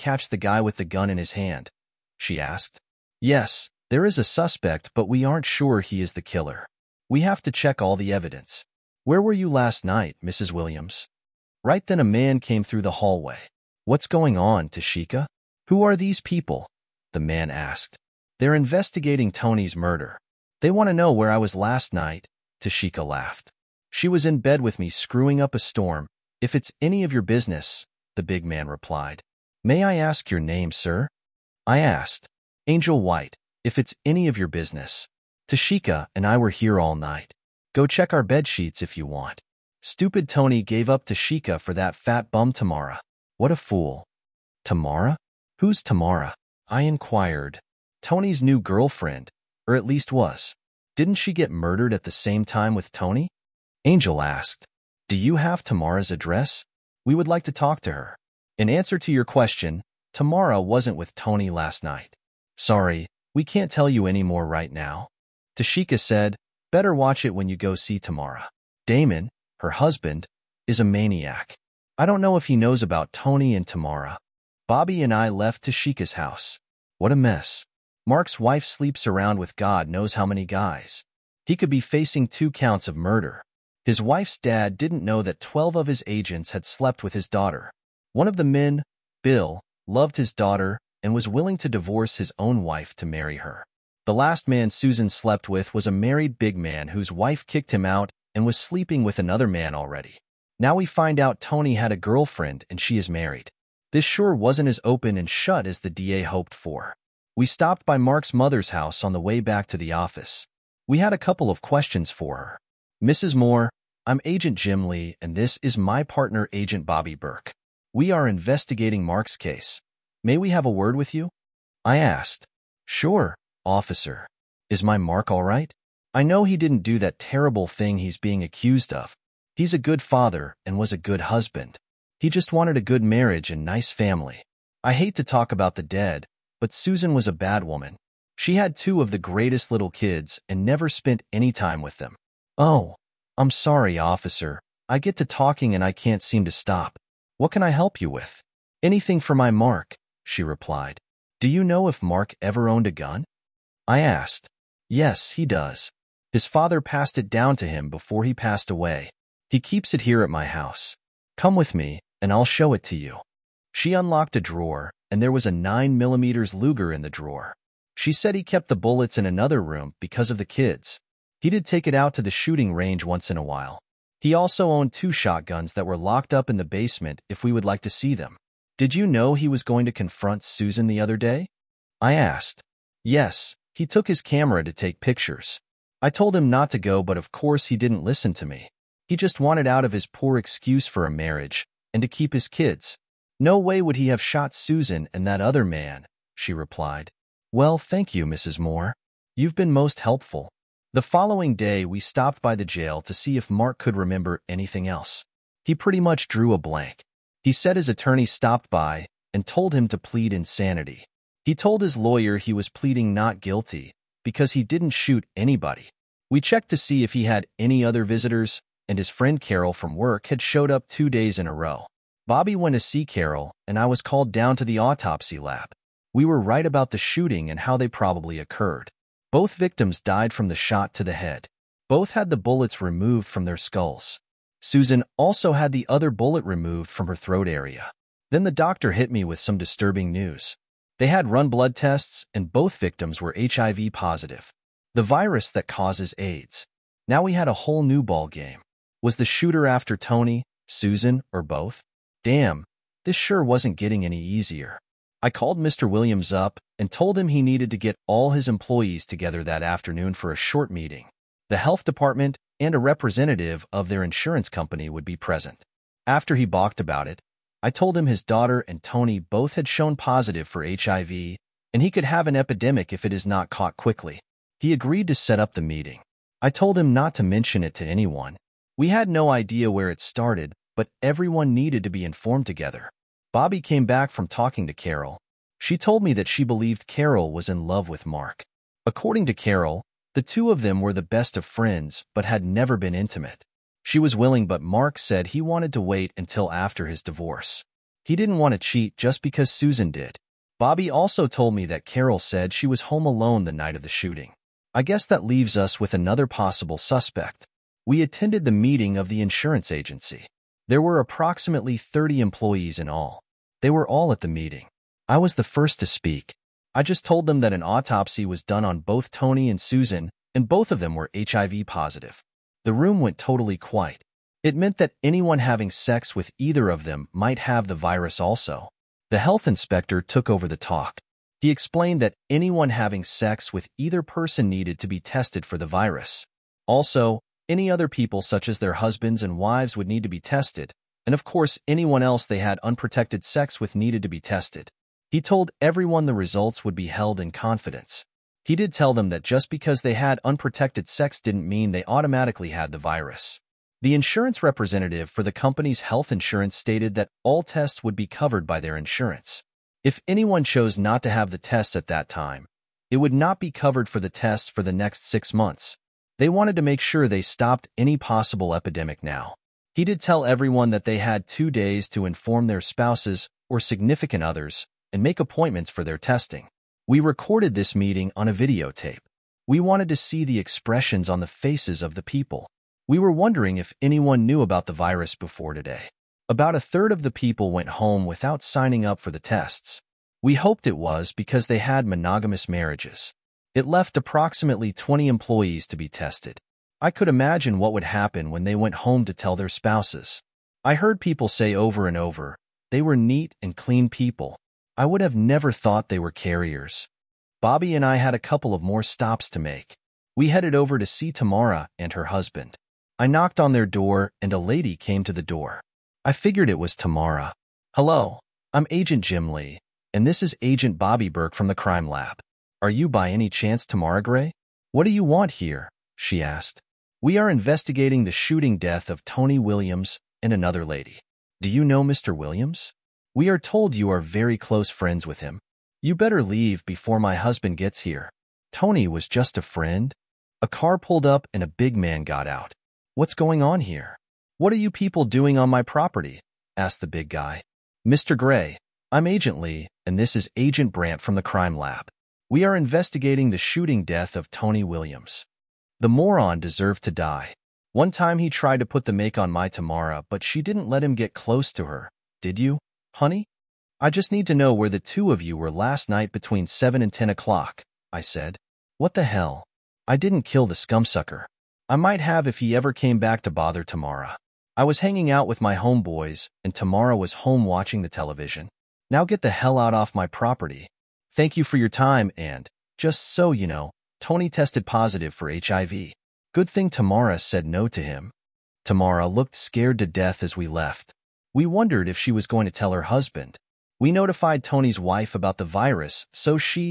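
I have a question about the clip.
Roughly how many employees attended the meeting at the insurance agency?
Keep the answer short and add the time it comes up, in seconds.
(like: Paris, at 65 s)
30, at 311 s.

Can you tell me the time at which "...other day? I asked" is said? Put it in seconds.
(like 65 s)
180 s.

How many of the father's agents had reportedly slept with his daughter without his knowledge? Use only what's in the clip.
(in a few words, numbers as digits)
12.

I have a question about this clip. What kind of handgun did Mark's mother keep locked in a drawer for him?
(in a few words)
9mm Luger.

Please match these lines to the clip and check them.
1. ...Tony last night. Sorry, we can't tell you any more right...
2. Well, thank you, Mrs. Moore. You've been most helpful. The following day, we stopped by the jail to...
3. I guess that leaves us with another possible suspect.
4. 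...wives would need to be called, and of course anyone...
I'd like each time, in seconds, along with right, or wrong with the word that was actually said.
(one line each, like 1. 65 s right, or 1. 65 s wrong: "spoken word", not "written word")
1. 61 s right
2. 197 s right
3. 304 s right
4. 339 s wrong: "tested", not "called".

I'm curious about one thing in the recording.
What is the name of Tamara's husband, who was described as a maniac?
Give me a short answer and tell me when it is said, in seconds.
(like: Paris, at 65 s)
Damon, at 68 s.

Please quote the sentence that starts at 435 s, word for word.
You better leave before my husband gets here.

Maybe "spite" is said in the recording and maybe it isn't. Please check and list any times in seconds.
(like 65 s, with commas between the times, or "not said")
not said.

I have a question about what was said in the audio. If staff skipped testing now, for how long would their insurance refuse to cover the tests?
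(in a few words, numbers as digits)
6 months.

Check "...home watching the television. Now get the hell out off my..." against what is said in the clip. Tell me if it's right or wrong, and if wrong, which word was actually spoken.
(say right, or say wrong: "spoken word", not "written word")
right.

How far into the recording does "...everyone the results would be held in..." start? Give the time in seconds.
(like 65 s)
345 s.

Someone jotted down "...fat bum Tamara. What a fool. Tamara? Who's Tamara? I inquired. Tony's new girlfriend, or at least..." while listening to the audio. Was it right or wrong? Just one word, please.
right.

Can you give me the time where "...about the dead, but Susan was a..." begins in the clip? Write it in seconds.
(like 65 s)
135 s.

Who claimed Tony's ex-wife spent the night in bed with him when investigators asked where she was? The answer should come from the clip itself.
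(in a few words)
Angel White.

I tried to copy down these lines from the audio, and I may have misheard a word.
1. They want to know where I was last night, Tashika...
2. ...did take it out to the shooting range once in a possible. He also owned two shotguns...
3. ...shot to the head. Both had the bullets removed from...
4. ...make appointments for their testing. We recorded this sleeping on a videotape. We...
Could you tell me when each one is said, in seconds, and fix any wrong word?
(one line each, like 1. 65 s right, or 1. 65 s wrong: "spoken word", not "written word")
1. 20 s right
2. 171 s wrong: "while", not "possible"
3. 230 s right
4. 375 s wrong: "meeting", not "sleeping".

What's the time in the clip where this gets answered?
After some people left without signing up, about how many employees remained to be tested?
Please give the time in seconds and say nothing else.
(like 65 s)
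394 s.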